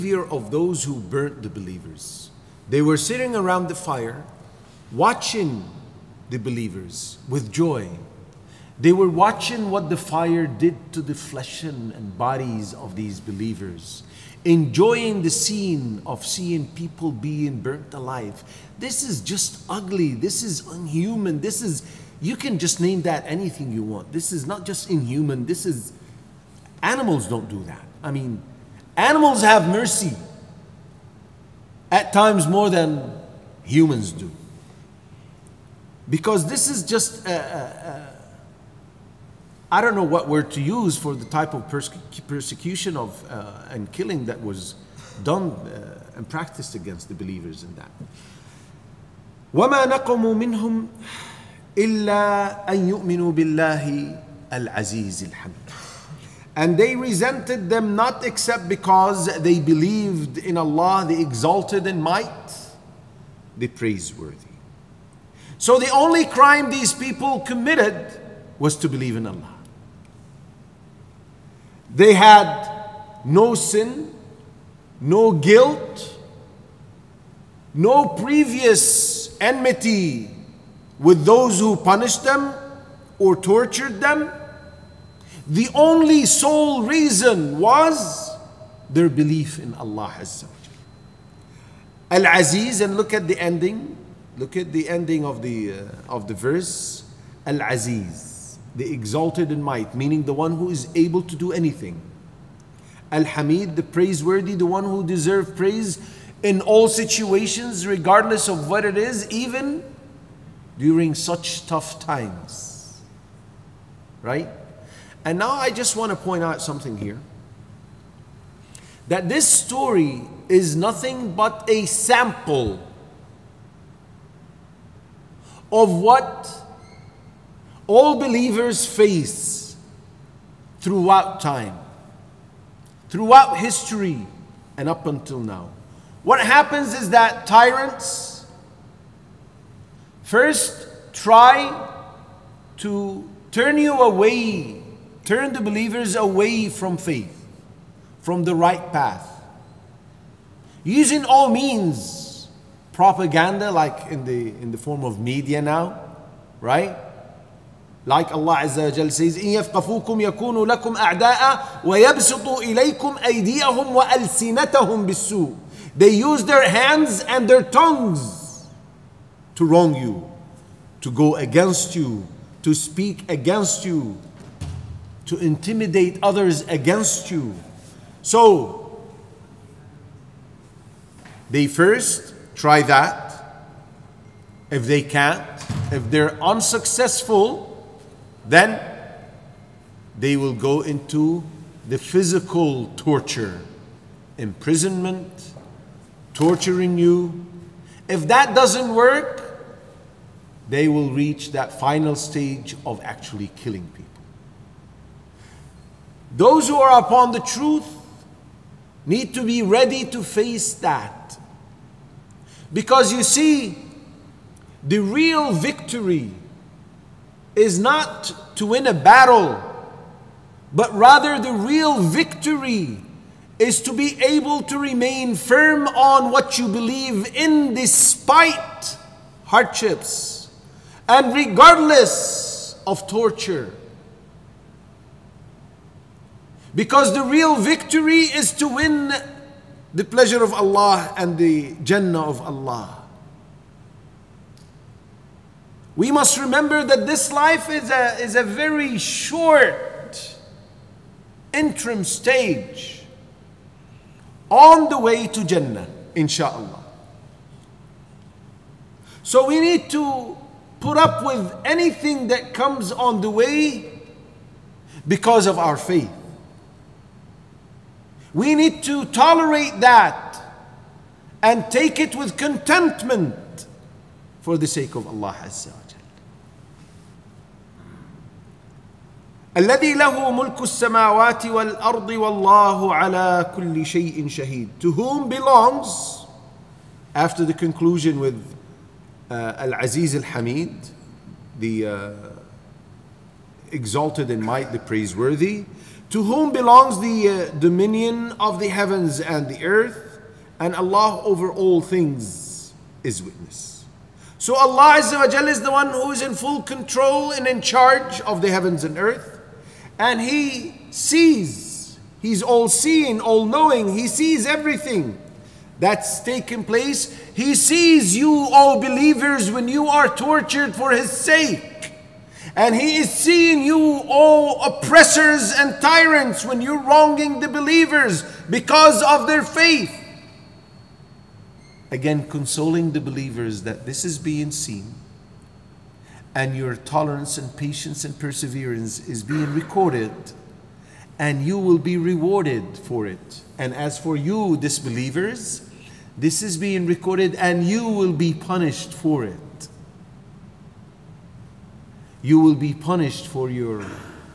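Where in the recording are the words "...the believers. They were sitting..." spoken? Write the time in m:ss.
0:01.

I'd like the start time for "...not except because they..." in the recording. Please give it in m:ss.
0:57.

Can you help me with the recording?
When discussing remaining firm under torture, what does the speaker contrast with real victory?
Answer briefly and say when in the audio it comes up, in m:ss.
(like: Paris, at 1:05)
To win a battle, at 3:38.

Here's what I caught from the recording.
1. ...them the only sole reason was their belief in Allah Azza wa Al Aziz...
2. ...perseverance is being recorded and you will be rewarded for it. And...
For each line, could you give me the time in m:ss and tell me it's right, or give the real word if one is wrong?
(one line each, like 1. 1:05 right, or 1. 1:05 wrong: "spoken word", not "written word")
1. 1:24 right
2. 5:38 right.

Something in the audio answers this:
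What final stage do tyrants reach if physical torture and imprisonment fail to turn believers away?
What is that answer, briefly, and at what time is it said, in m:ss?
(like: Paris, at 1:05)
Killing people, at 3:23.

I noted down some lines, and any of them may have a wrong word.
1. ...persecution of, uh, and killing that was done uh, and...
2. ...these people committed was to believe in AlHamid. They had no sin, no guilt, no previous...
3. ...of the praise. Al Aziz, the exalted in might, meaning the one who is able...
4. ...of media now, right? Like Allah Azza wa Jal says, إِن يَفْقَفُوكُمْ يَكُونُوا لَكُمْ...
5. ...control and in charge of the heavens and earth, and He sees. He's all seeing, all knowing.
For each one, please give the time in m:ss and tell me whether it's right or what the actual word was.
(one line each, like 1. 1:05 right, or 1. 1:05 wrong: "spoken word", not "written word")
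1. 0:42 right
2. 1:06 wrong: "Allah", not "AlHamid"
3. 1:36 wrong: "verse", not "praise"
4. 2:35 right
5. 5:06 right.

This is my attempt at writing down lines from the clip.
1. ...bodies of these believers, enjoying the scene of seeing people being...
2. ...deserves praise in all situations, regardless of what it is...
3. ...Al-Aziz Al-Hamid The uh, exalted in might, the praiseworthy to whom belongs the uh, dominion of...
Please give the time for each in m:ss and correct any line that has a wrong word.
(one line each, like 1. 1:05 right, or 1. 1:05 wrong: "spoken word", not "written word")
1. 0:12 right
2. 1:45 right
3. 4:49 right.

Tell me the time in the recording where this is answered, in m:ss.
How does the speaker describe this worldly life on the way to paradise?
4:08.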